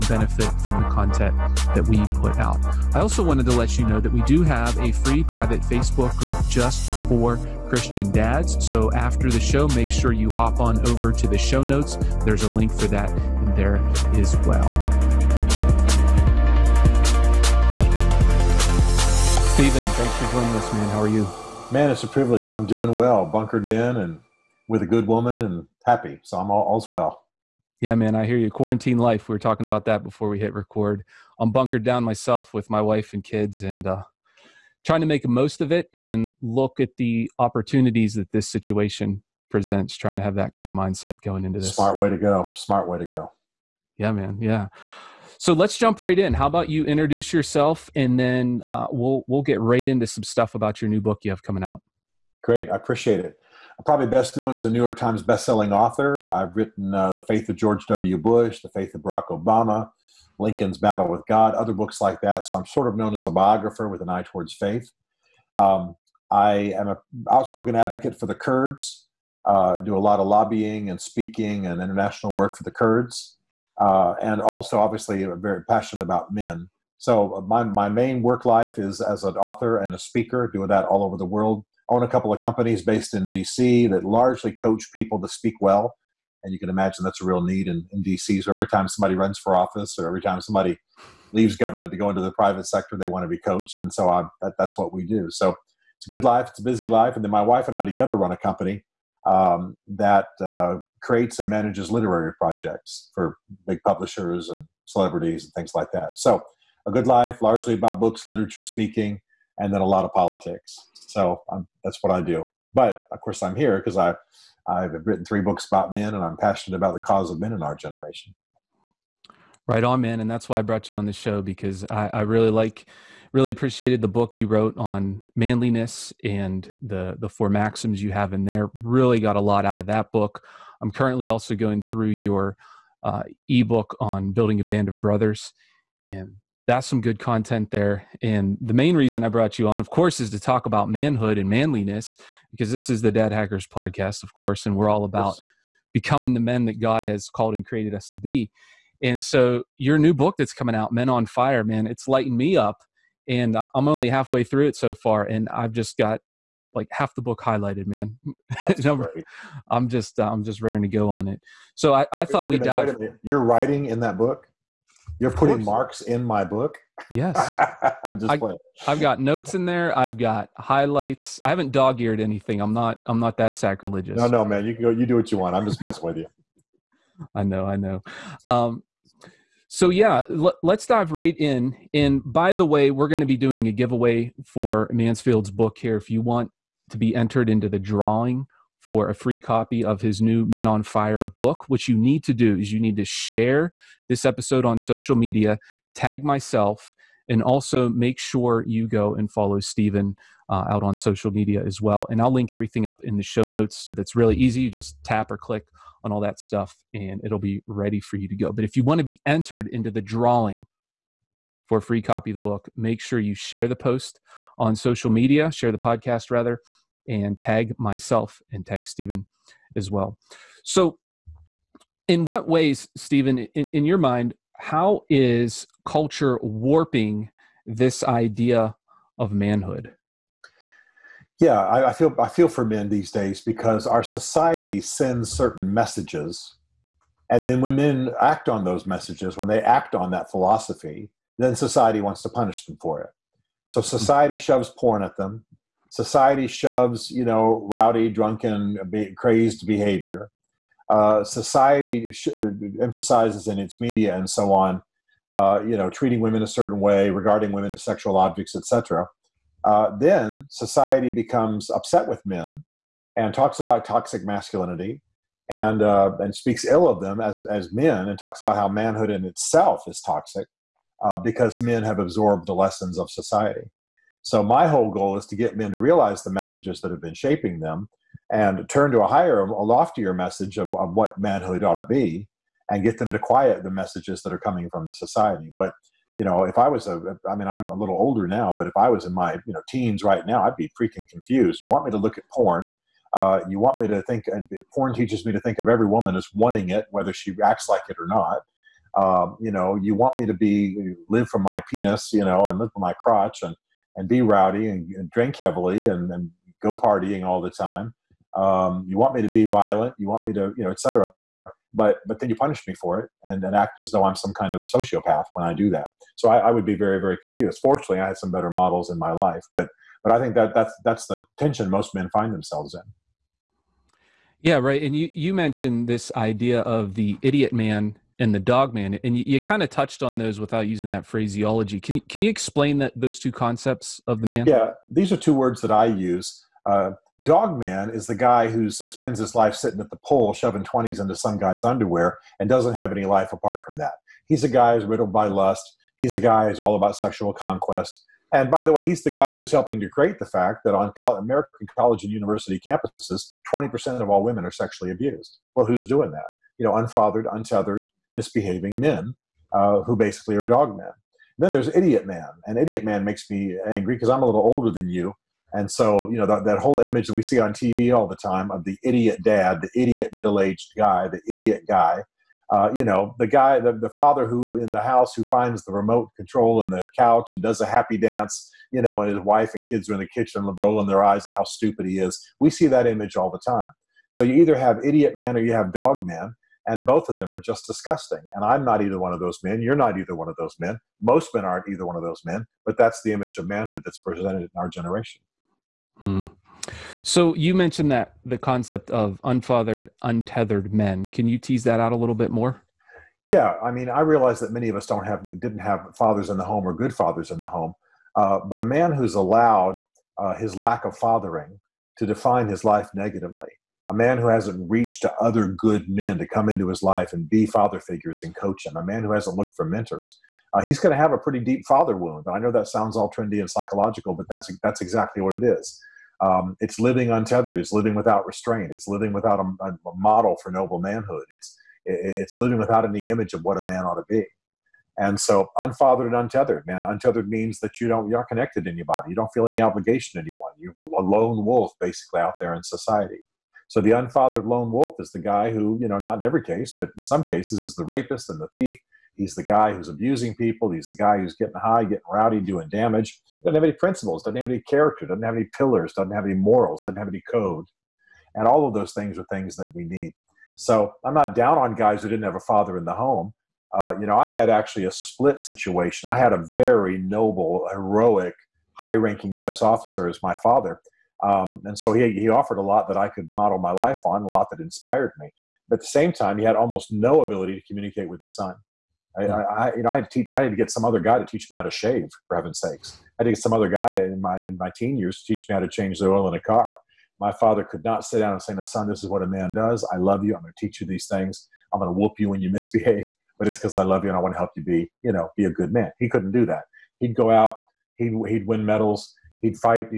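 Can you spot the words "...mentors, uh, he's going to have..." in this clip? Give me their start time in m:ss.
6:59.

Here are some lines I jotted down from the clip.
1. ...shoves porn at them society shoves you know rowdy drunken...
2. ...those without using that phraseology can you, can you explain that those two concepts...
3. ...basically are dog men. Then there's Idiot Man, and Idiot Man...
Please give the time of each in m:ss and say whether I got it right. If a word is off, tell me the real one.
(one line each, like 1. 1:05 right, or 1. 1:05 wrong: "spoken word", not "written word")
1. 4:04 right
2. 5:30 right
3. 5:59 right.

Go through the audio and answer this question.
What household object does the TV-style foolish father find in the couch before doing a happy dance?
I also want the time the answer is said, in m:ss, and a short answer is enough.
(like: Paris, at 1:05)
the remote control, at 6:15.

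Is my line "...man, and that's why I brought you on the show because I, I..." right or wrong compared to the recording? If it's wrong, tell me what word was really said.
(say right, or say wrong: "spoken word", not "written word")
right.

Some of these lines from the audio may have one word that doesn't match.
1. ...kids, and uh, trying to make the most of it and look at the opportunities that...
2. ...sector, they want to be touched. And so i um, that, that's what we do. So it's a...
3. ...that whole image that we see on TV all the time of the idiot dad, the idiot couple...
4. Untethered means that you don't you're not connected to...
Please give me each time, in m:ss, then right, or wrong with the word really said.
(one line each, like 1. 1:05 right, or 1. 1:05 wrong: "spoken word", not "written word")
1. 0:33 right
2. 1:32 wrong: "coached", not "touched"
3. 6:06 wrong: "middle", not "couple"
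4. 7:16 right.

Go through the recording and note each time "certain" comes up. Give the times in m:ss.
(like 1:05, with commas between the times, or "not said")
3:55, 4:16.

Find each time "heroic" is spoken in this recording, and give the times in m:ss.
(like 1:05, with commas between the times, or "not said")
7:47.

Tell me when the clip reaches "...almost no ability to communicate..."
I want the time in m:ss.
7:56.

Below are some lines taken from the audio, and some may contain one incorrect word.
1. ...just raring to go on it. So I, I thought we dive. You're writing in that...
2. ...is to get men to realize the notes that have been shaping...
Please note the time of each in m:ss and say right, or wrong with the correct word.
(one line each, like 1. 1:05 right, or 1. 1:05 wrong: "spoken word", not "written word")
1. 2:40 right
2. 4:35 wrong: "messages", not "notes".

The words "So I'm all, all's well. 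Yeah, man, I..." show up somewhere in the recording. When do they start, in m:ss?
0:26.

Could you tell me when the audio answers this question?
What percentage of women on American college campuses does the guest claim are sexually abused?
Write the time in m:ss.
5:53.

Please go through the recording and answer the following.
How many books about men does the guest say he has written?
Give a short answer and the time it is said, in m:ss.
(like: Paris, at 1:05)
3, at 1:55.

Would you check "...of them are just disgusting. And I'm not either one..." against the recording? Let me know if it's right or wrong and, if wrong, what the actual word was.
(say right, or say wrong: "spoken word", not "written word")
right.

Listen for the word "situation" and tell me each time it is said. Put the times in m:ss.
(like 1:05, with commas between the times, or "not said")
0:38, 7:45.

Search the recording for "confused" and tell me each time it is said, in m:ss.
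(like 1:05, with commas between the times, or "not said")
4:51, 5:17.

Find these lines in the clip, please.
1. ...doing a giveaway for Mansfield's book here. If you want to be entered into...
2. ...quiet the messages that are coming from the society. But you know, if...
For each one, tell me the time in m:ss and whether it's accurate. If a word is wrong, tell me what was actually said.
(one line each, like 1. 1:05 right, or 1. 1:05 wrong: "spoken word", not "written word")
1. 3:03 right
2. 4:43 right.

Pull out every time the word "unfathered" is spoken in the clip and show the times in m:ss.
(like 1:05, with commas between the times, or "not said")
5:56, 6:39, 7:15, 7:23.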